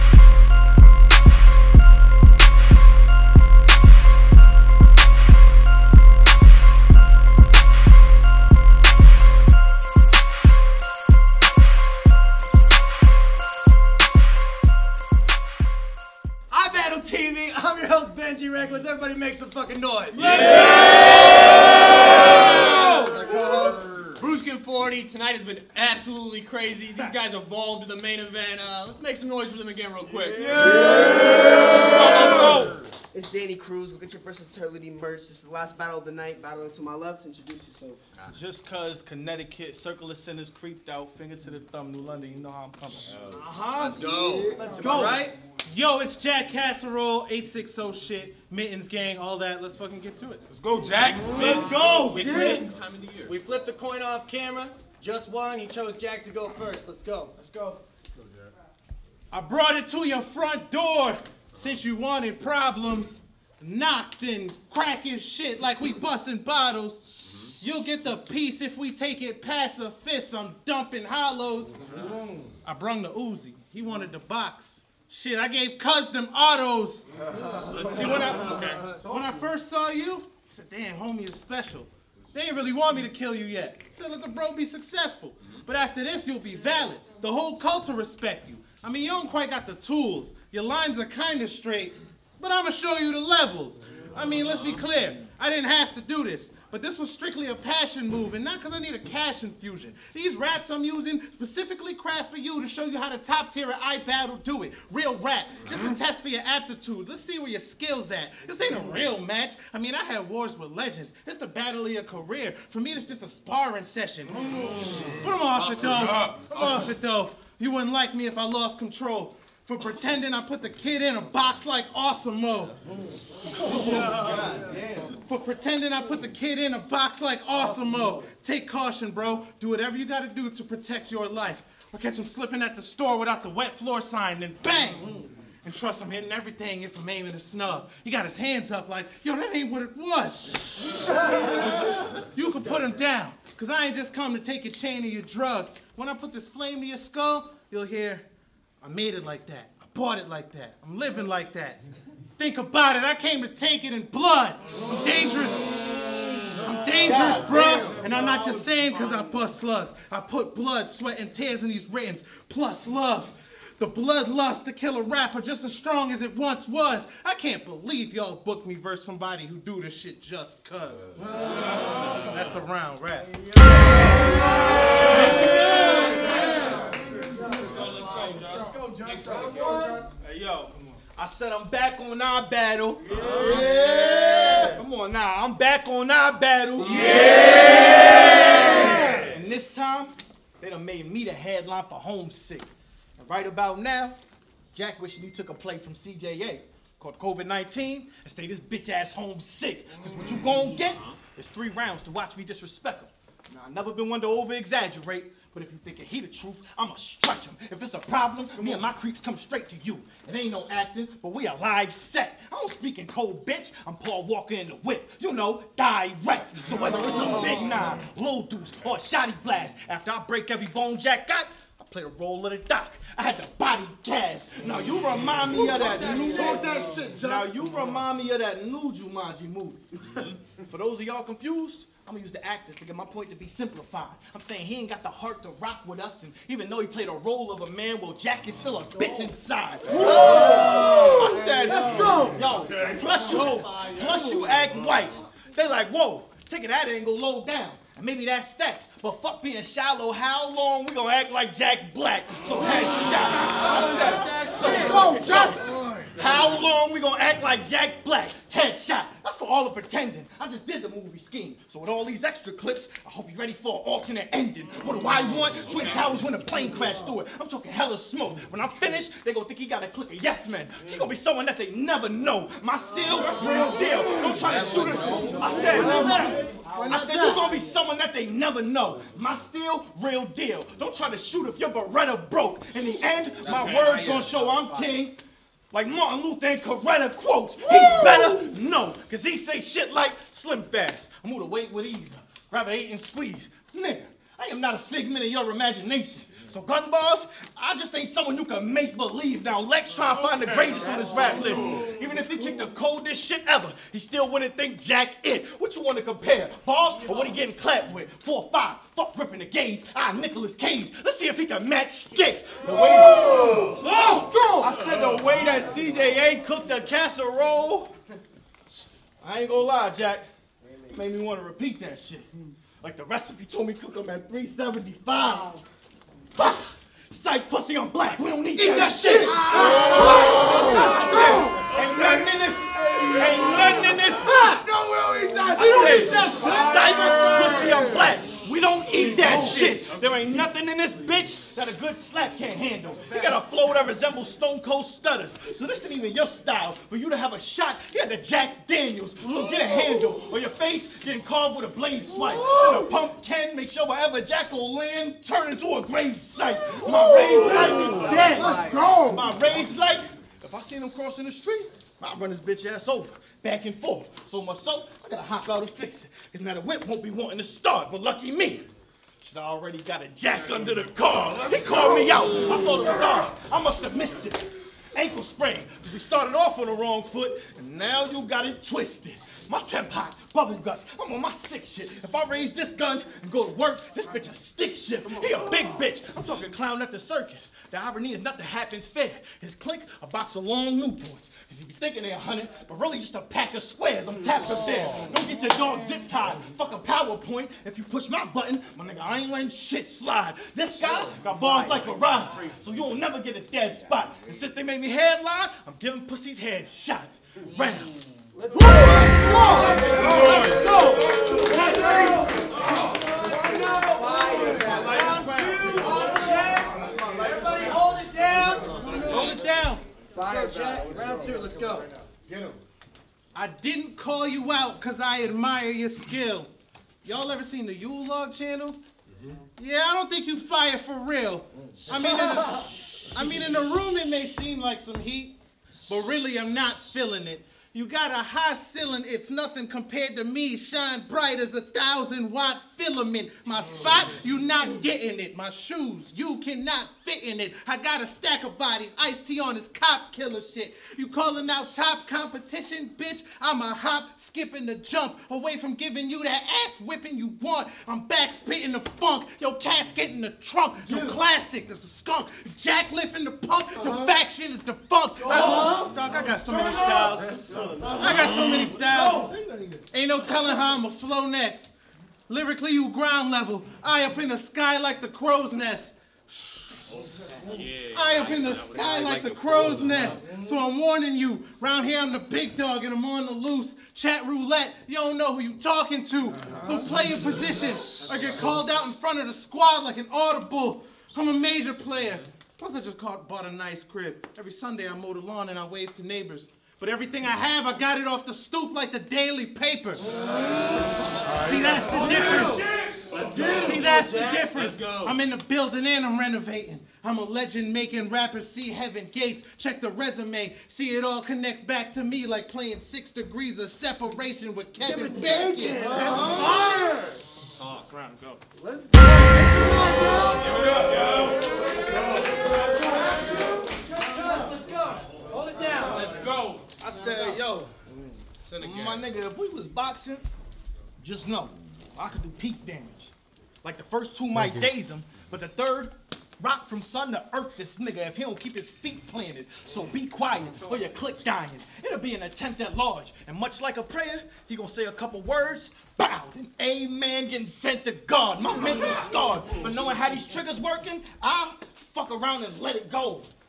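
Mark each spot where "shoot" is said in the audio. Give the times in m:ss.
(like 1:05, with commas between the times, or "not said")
4:34, 4:41.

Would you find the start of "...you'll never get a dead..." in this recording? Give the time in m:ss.
6:42.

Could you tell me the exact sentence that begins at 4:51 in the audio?
I'm gonna wait with ease, grab a eight and squeeze.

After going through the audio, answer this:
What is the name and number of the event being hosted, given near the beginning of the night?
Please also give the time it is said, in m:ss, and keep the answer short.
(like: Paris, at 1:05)
Bruskin 40, at 0:24.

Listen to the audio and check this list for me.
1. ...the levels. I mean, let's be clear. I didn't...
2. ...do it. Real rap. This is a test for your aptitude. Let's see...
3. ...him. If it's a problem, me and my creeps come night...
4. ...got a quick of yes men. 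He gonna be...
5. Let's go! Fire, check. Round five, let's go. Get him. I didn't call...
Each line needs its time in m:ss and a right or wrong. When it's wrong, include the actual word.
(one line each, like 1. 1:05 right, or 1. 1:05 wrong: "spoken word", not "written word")
1. 1:33 right
2. 1:44 right
3. 3:27 wrong: "straight", not "night"
4. 4:29 wrong: "click", not "quick"
5. 6:58 wrong: "two", not "five".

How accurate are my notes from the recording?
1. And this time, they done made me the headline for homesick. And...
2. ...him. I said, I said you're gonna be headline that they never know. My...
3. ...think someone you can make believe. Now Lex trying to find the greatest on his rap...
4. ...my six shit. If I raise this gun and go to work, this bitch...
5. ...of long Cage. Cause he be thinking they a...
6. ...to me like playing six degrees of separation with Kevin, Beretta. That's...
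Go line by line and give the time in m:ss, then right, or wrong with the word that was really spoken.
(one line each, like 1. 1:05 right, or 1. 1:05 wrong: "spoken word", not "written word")
1. 3:09 right
2. 4:34 wrong: "someone", not "headline"
3. 4:57 right
4. 6:21 right
5. 6:30 wrong: "Newports", not "Cage"
6. 8:31 wrong: "Bacon", not "Beretta".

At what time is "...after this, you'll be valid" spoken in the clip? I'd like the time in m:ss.
1:25.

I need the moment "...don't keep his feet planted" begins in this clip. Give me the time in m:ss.
8:58.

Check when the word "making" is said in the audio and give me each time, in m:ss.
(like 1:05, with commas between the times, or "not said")
8:27.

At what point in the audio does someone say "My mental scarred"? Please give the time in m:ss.
9:08.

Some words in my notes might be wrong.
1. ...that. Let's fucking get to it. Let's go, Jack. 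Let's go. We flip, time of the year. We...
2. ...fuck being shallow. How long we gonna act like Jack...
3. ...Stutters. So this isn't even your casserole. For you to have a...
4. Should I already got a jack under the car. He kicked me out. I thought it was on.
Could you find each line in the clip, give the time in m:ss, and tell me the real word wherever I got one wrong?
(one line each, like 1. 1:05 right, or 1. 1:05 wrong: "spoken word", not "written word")
1. 0:49 right
2. 4:09 right
3. 5:44 wrong: "style", not "casserole"
4. 6:09 wrong: "called", not "kicked".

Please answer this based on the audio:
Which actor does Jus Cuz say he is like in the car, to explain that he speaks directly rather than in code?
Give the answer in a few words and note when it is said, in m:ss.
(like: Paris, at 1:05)
Paul Walker, at 3:33.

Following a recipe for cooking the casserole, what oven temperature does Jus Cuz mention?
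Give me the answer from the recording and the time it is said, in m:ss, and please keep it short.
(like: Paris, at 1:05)
375, at 5:24.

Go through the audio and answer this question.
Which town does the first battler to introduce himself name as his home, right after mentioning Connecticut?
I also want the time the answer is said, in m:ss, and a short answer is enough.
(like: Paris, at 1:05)
New London, at 0:41.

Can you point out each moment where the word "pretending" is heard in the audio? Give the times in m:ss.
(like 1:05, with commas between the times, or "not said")
1:59, 2:05, 4:19.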